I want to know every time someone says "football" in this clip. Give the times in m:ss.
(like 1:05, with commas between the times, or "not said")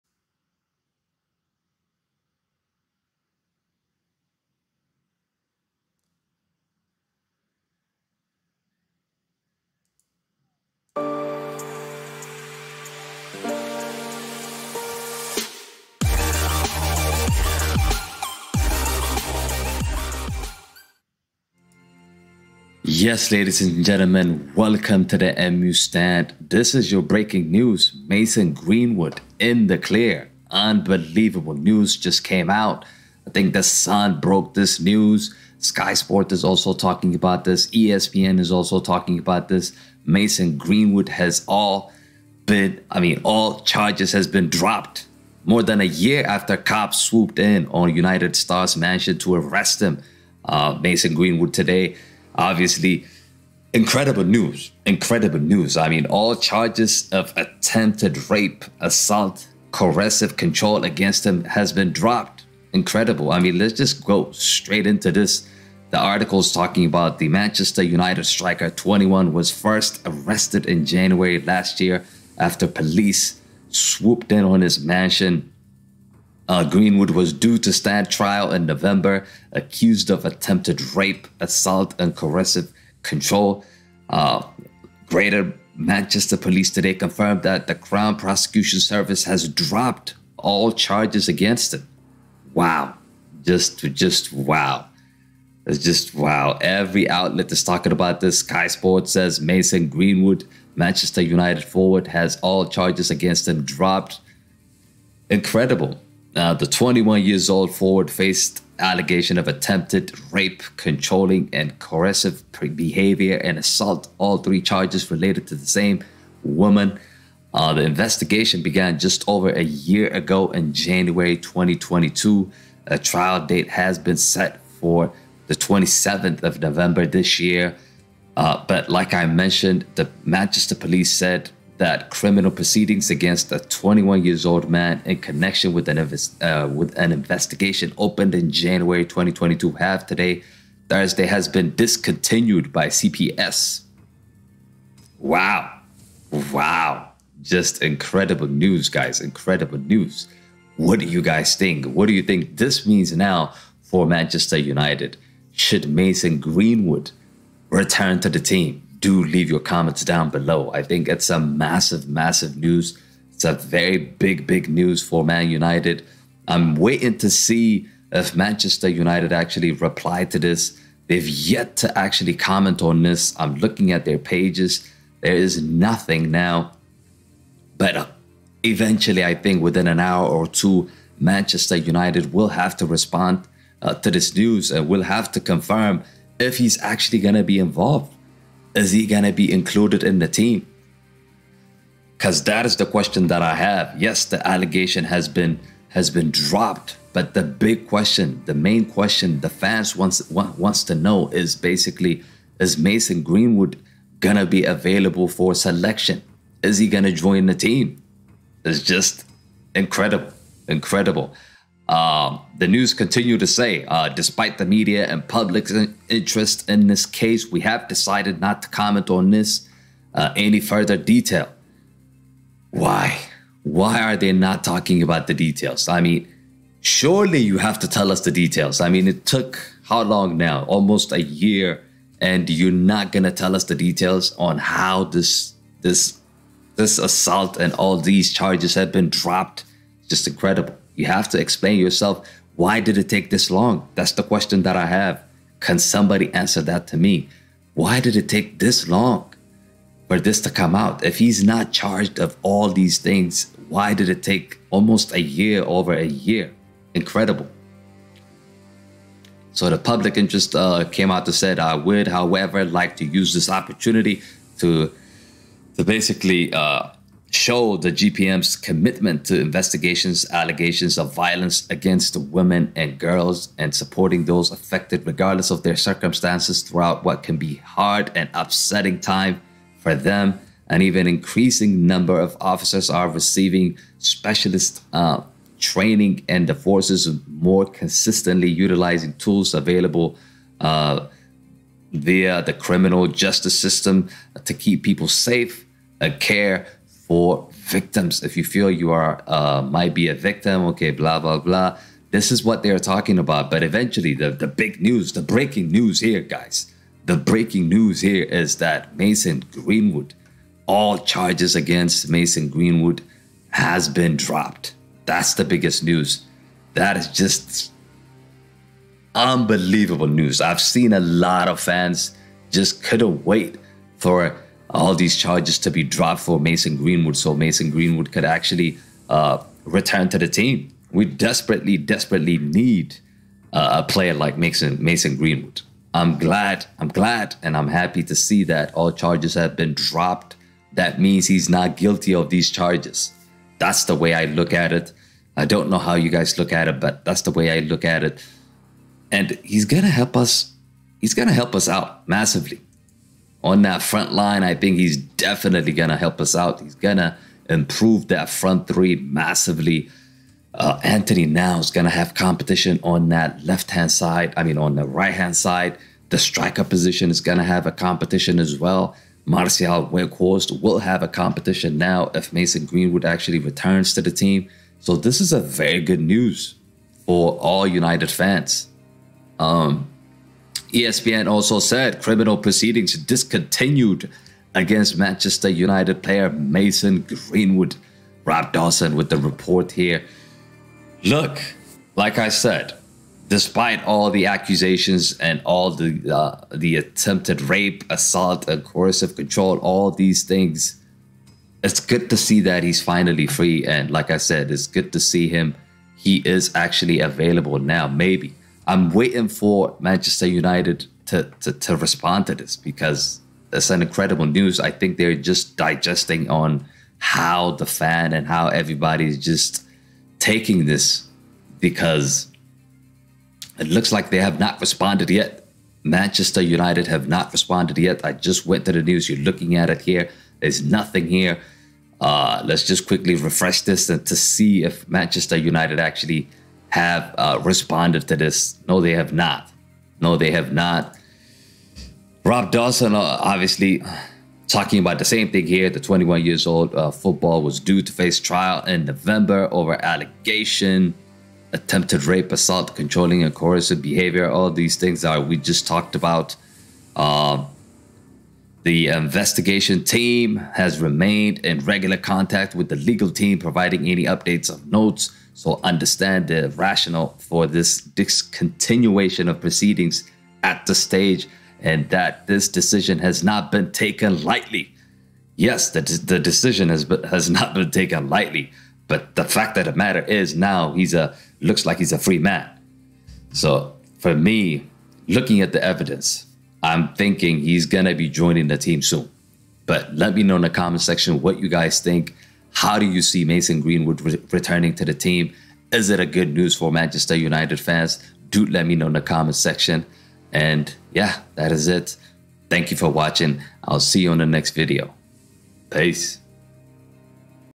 7:26.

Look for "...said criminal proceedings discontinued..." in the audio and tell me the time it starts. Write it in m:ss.
6:21.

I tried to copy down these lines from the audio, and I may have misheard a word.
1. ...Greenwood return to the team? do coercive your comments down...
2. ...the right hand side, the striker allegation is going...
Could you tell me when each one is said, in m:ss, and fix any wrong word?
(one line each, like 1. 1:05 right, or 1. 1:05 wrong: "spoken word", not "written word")
1. 2:36 wrong: "leave", not "coercive"
2. 6:04 wrong: "position", not "allegation".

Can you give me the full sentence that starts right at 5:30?
We desperately, desperately need uh, a player like Mason, Mason Greenwood.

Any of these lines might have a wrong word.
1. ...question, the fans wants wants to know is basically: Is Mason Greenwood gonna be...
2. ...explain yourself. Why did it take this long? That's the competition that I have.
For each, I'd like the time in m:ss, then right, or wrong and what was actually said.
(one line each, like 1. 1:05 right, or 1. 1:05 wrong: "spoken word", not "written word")
1. 3:18 right
2. 4:01 wrong: "question", not "competition".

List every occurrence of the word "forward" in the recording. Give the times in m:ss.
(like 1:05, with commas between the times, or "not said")
1:41, 1:47.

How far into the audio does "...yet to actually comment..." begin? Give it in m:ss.
2:51.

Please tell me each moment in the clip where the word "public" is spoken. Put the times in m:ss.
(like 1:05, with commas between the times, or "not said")
3:35, 4:19.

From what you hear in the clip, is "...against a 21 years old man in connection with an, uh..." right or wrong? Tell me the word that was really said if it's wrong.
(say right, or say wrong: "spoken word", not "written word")
right.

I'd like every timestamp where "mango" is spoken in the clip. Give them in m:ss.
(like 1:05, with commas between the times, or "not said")
not said.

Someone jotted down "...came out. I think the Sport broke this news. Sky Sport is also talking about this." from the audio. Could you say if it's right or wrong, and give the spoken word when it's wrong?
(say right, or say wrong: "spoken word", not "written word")
wrong: "Sun", not "Sport".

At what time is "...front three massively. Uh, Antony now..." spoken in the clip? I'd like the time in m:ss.
5:58.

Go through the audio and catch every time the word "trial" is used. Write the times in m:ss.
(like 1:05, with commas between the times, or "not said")
1:18, 2:02, 7:28.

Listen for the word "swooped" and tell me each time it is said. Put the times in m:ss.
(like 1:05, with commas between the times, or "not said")
0:47, 1:13.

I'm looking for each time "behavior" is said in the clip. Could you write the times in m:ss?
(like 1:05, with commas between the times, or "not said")
1:52, 7:33.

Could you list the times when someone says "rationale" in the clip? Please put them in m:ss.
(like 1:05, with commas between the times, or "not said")
7:46.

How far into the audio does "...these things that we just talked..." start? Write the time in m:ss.
7:34.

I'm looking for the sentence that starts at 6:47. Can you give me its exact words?
Maybe I'm waiting for Manchester United to, to, to respond to this because it's an incredible news.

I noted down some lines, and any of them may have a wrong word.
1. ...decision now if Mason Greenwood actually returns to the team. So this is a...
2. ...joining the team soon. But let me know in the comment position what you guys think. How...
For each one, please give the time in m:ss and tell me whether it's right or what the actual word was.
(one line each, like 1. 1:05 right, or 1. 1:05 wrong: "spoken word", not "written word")
1. 6:11 wrong: "competition", not "decision"
2. 8:08 wrong: "section", not "position".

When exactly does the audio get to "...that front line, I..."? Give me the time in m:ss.
5:53.